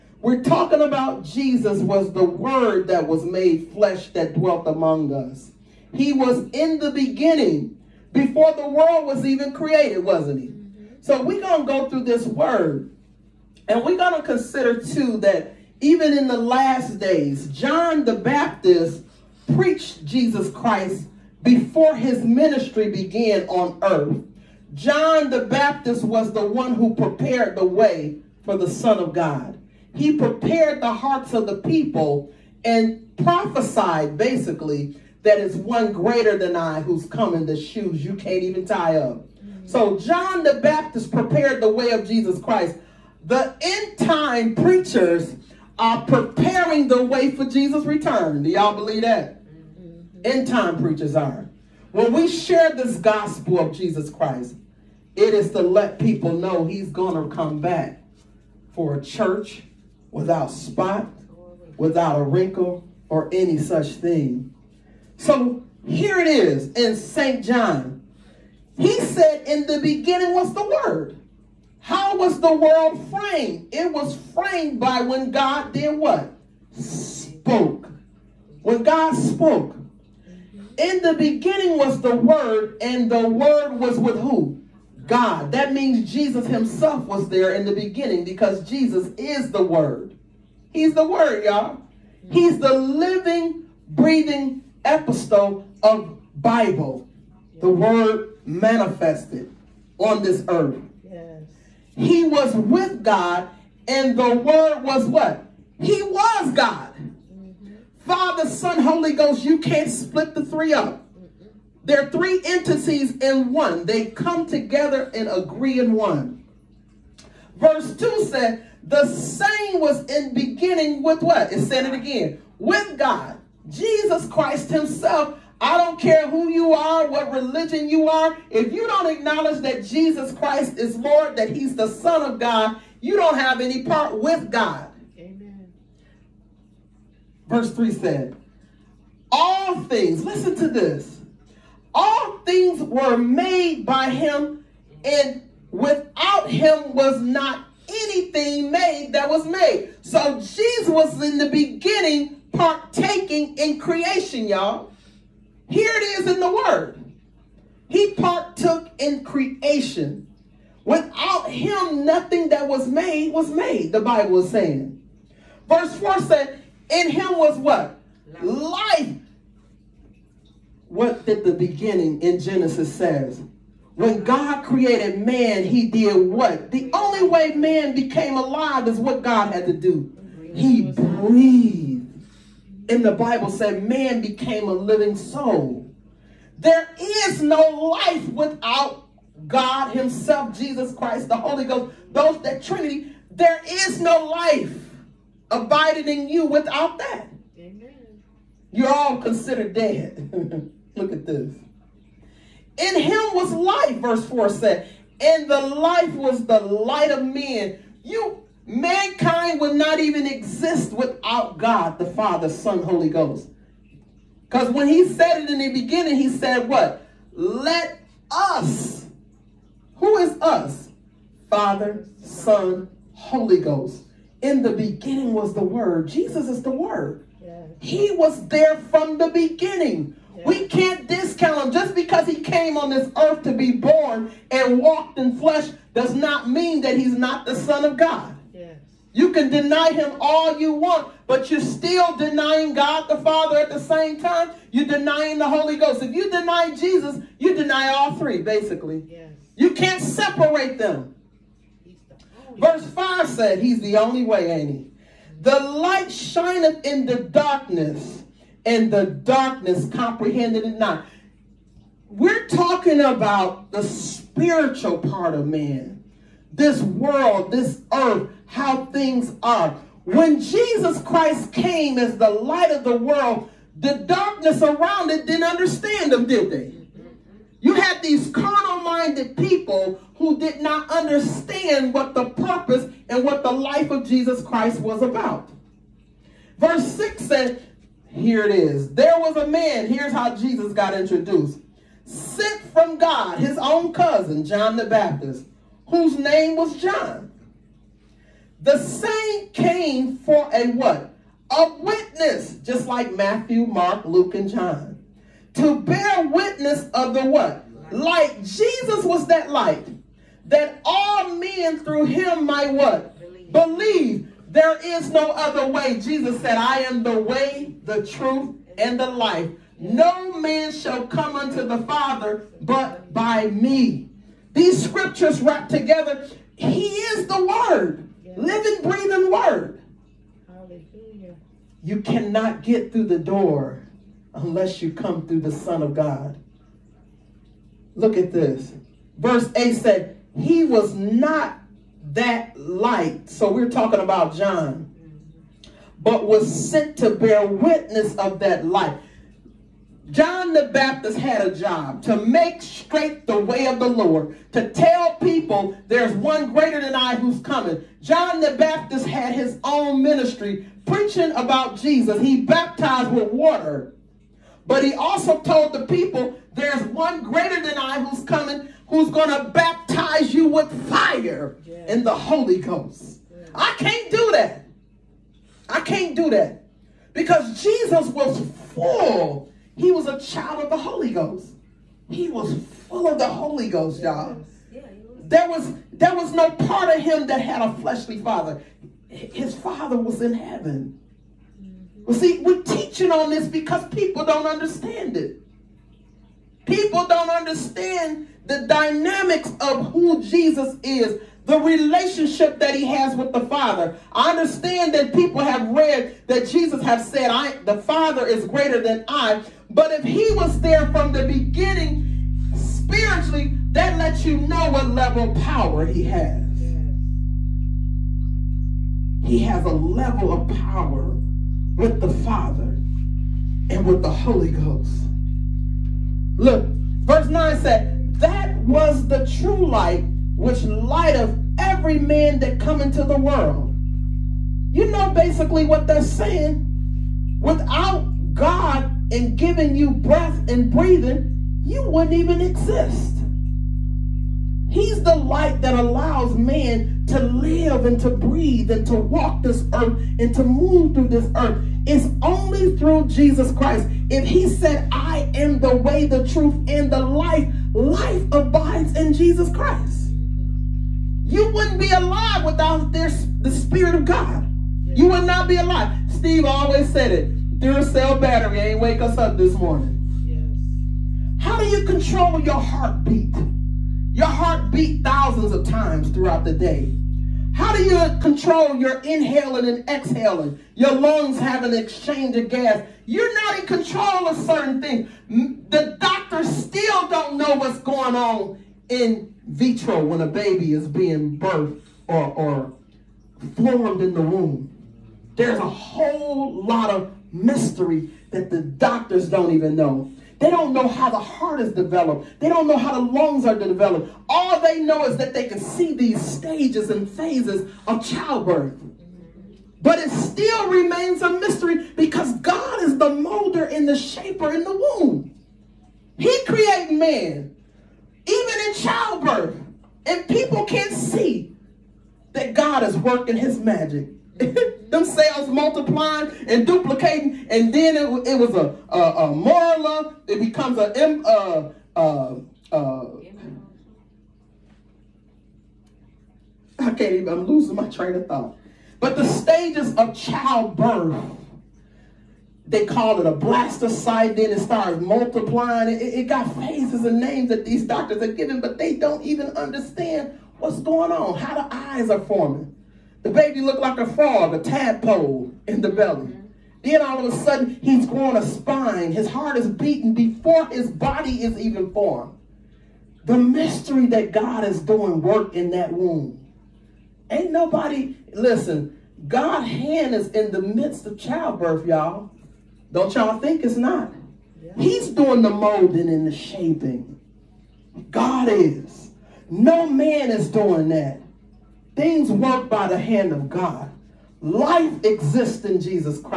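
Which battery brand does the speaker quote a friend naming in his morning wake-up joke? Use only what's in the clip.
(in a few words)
Duracell.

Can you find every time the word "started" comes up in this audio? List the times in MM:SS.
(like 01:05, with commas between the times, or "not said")
09:04.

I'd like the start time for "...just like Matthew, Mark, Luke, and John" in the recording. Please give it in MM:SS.
05:02.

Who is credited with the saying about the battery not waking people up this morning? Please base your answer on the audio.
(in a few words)
Steve.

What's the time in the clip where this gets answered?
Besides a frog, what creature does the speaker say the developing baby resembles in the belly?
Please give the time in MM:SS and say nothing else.
09:14.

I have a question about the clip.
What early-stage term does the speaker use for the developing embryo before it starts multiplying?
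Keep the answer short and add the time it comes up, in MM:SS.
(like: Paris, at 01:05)
blastocyte, at 09:03.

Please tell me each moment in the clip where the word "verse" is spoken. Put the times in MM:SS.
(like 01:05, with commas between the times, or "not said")
01:57, 02:17, 02:45, 03:23, 04:12, 04:46, 05:39, 07:07.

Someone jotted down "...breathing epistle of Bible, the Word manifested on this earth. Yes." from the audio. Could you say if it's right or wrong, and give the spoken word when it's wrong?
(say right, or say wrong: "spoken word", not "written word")
right.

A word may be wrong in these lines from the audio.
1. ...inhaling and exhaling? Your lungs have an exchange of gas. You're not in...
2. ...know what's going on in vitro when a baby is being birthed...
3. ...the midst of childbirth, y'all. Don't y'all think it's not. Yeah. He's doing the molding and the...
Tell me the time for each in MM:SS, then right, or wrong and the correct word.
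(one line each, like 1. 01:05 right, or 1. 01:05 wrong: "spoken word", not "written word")
1. 07:58 right
2. 08:07 right
3. 09:30 right.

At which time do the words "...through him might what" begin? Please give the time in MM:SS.
05:11.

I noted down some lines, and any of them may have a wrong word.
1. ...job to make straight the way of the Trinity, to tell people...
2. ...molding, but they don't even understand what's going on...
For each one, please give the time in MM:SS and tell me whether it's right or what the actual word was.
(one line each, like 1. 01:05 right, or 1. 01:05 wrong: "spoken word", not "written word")
1. 05:51 wrong: "Lord", not "Trinity"
2. 09:08 wrong: "giving", not "molding".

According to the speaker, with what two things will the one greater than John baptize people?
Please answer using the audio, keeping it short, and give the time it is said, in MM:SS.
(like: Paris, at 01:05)
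fire and the Holy Ghost, at 06:10.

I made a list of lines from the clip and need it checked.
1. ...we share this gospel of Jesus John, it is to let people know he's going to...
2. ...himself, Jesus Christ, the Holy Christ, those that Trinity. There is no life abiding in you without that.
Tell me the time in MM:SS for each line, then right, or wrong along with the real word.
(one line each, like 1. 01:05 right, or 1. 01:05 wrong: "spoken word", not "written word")
1. 00:52 wrong: "Christ", not "John"
2. 03:09 wrong: "Ghost", not "Christ".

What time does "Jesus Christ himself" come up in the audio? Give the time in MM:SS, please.
02:03.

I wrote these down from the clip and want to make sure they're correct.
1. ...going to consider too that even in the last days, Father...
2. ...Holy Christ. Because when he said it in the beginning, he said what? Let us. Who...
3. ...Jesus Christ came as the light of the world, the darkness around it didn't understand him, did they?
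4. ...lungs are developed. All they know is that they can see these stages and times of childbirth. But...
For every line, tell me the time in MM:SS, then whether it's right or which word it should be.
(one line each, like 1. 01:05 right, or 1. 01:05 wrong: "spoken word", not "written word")
1. 00:13 wrong: "John", not "Father"
2. 03:32 wrong: "Ghost", not "Christ"
3. 04:30 right
4. 08:23 wrong: "phases", not "times".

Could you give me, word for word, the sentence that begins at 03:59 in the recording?
You can deny him all you want, but you're still denying God the Father at the same time.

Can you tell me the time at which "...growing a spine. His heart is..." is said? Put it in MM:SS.
09:18.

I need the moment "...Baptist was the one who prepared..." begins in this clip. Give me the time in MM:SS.
00:25.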